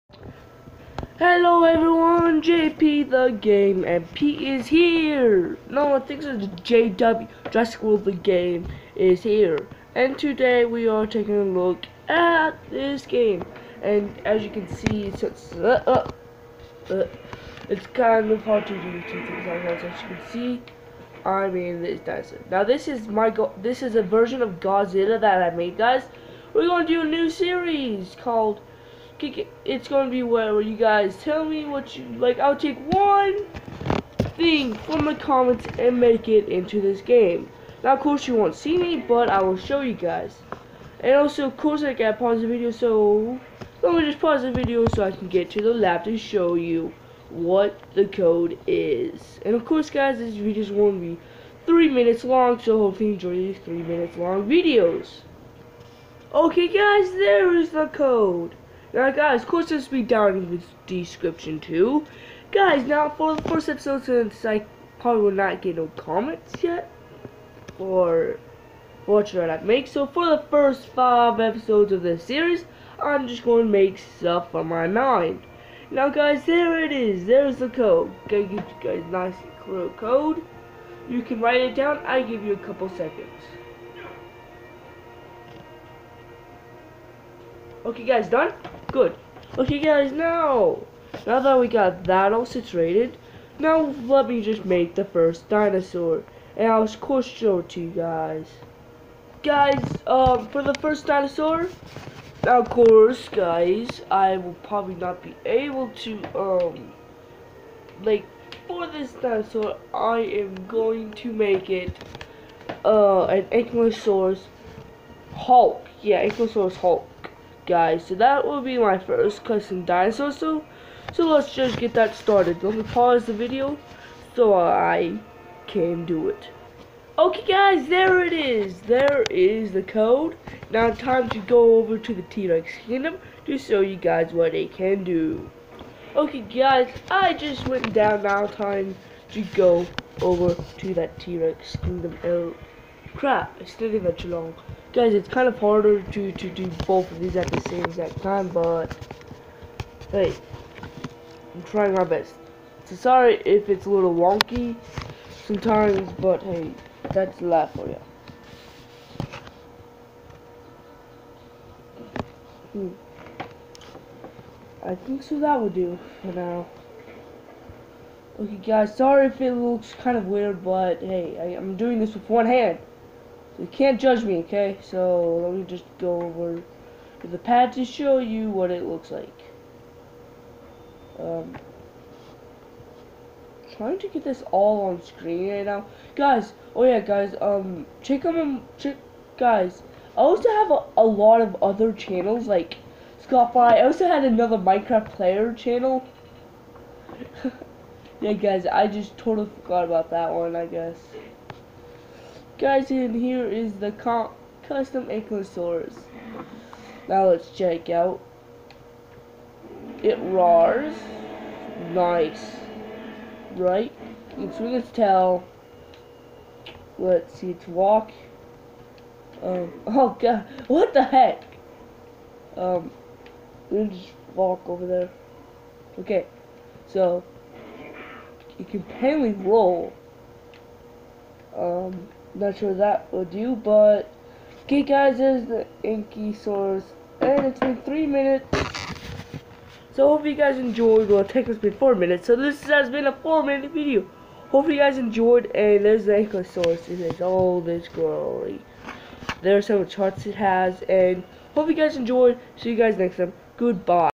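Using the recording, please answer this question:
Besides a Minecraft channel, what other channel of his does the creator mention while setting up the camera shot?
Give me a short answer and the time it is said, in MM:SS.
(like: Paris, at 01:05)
Scott Fry, at 03:13.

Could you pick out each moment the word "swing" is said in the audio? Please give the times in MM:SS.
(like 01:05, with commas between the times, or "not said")
03:34.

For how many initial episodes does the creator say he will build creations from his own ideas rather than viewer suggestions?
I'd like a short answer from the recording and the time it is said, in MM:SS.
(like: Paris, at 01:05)
5, at 01:10.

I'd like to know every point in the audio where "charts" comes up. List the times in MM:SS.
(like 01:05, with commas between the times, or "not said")
04:09.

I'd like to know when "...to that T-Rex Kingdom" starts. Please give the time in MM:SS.
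02:20.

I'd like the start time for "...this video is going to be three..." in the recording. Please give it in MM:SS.
00:50.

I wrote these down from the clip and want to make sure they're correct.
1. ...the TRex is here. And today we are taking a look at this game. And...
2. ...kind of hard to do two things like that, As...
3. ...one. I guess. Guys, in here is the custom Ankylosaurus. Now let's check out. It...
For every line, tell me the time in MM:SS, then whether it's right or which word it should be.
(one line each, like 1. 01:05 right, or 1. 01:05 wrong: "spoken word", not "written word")
1. 00:08 wrong: "Game", not "TRex"
2. 00:17 right
3. 03:20 right.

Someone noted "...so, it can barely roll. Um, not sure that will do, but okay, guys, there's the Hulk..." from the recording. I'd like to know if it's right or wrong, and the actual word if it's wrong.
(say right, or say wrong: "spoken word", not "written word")
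wrong: "Inky", not "Hulk".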